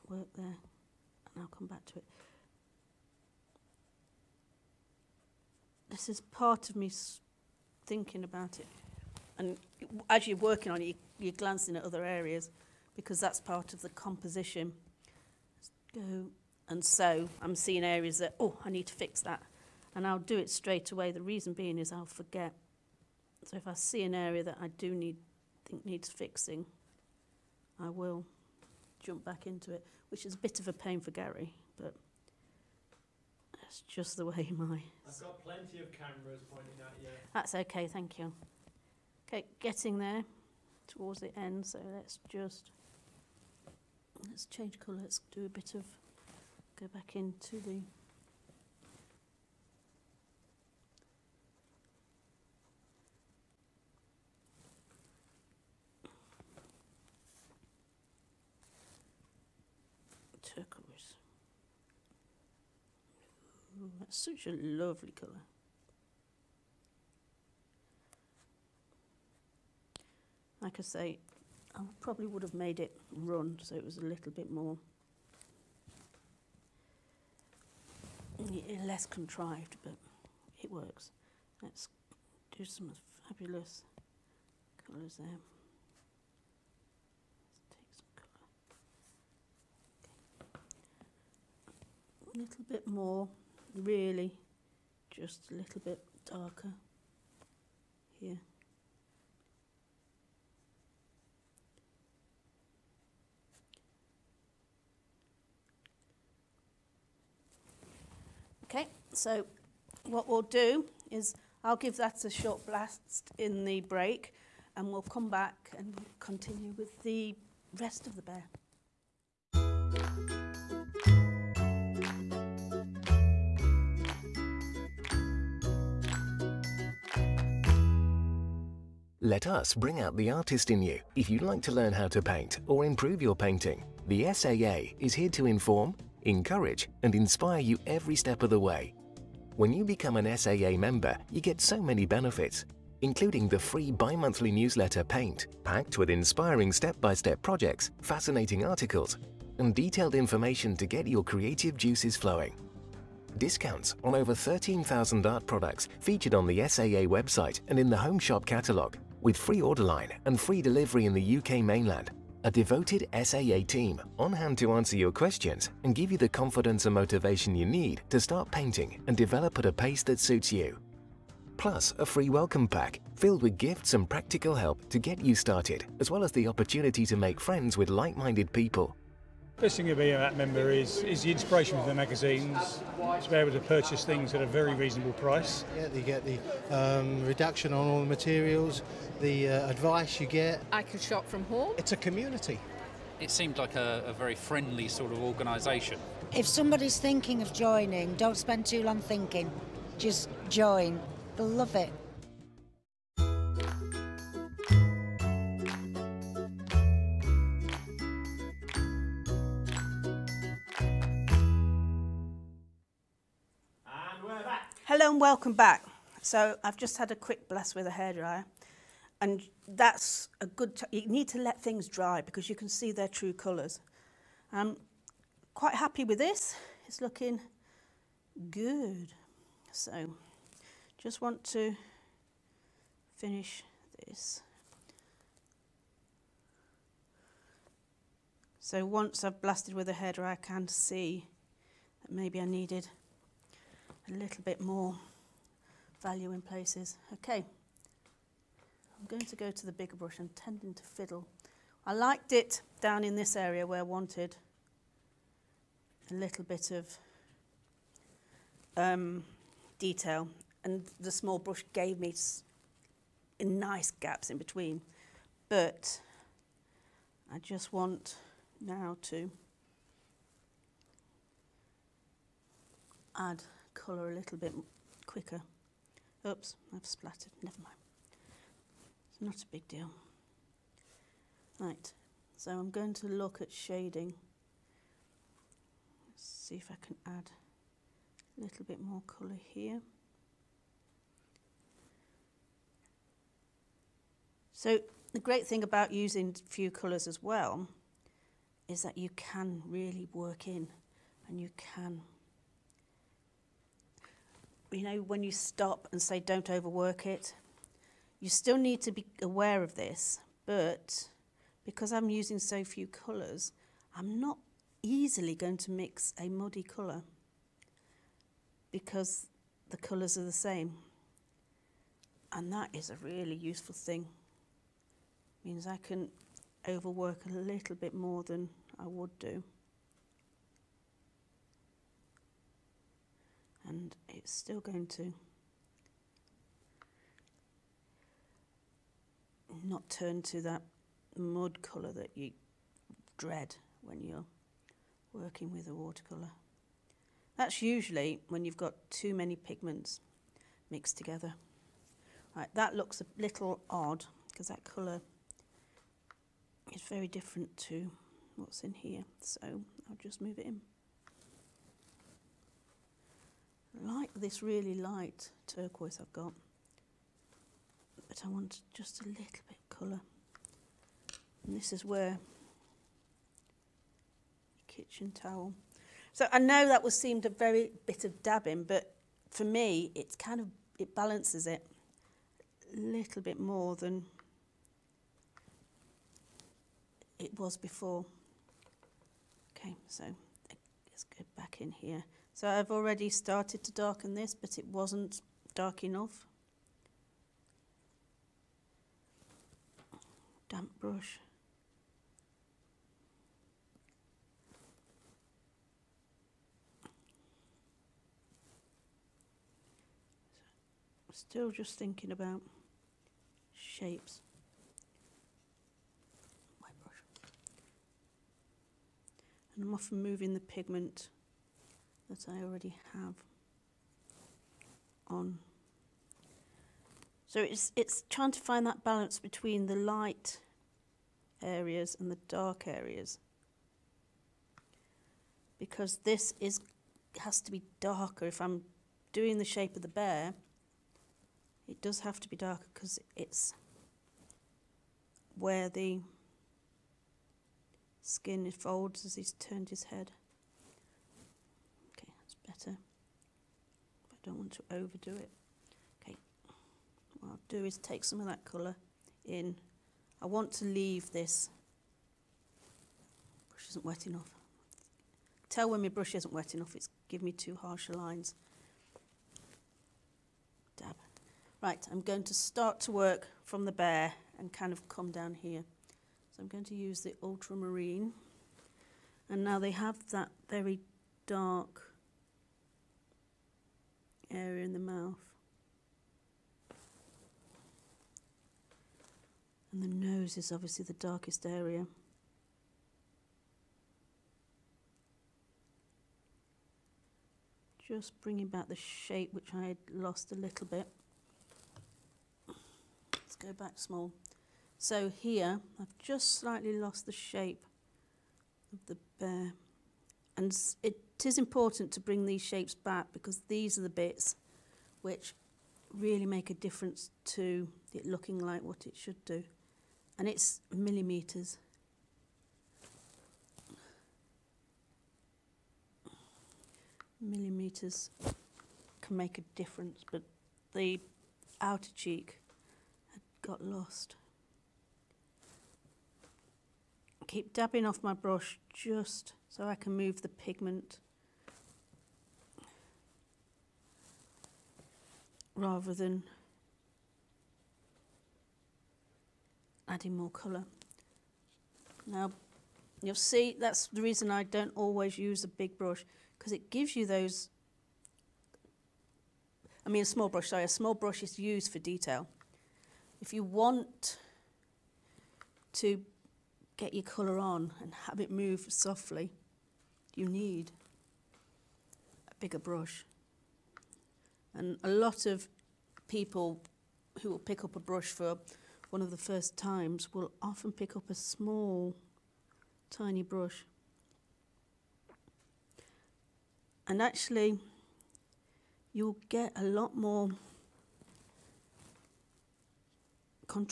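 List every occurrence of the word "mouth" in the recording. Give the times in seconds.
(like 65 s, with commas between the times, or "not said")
484 s.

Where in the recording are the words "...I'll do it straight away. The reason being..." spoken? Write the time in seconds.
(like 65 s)
20 s.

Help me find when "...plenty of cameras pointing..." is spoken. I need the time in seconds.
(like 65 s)
35 s.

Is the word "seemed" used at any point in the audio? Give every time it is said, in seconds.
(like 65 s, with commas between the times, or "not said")
193 s, 376 s.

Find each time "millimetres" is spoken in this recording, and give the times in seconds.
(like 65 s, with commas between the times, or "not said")
520 s, 527 s.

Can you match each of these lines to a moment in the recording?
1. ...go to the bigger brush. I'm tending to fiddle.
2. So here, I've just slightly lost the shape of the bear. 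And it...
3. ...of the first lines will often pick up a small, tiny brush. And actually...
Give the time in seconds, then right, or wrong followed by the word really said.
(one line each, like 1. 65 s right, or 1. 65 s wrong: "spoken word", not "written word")
1. 249 s right
2. 504 s right
3. 579 s wrong: "times", not "lines".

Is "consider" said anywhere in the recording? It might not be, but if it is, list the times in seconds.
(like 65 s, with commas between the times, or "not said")
not said.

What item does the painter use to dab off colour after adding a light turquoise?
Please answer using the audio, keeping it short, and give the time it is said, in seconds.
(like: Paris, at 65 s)
Kitchen towel, at 374 s.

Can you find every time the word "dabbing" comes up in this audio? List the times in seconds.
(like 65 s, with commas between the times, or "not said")
378 s, 537 s.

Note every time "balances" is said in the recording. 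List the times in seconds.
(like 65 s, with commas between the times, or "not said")
380 s, 428 s.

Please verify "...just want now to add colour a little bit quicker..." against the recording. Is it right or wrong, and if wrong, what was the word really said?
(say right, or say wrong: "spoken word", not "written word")
right.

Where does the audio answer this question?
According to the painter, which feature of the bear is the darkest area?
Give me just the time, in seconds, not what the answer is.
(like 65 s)
489 s.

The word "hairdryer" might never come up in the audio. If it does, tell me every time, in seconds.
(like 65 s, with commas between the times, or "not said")
217 s, 239 s.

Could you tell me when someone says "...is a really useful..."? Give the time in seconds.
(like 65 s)
322 s.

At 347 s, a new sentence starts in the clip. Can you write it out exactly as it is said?
That's usually when you've got too many pigments mixed together.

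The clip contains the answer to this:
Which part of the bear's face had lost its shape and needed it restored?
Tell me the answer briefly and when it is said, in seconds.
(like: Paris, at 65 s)
Outer cheek, at 531 s.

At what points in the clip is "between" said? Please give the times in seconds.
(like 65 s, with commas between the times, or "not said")
264 s, 429 s.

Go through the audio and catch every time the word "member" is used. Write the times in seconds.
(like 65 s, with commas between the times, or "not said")
140 s, 180 s.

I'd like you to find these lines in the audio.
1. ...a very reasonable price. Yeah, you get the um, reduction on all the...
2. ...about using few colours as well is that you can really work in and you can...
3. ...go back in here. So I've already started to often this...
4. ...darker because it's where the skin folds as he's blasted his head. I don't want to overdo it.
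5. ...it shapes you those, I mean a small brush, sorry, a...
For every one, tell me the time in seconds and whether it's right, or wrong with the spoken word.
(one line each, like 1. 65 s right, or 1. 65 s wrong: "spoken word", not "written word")
1. 184 s right
2. 295 s right
3. 391 s wrong: "darken", not "often"
4. 442 s wrong: "turned", not "blasted"
5. 556 s wrong: "gives", not "shapes".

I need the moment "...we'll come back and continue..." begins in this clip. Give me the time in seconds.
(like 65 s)
114 s.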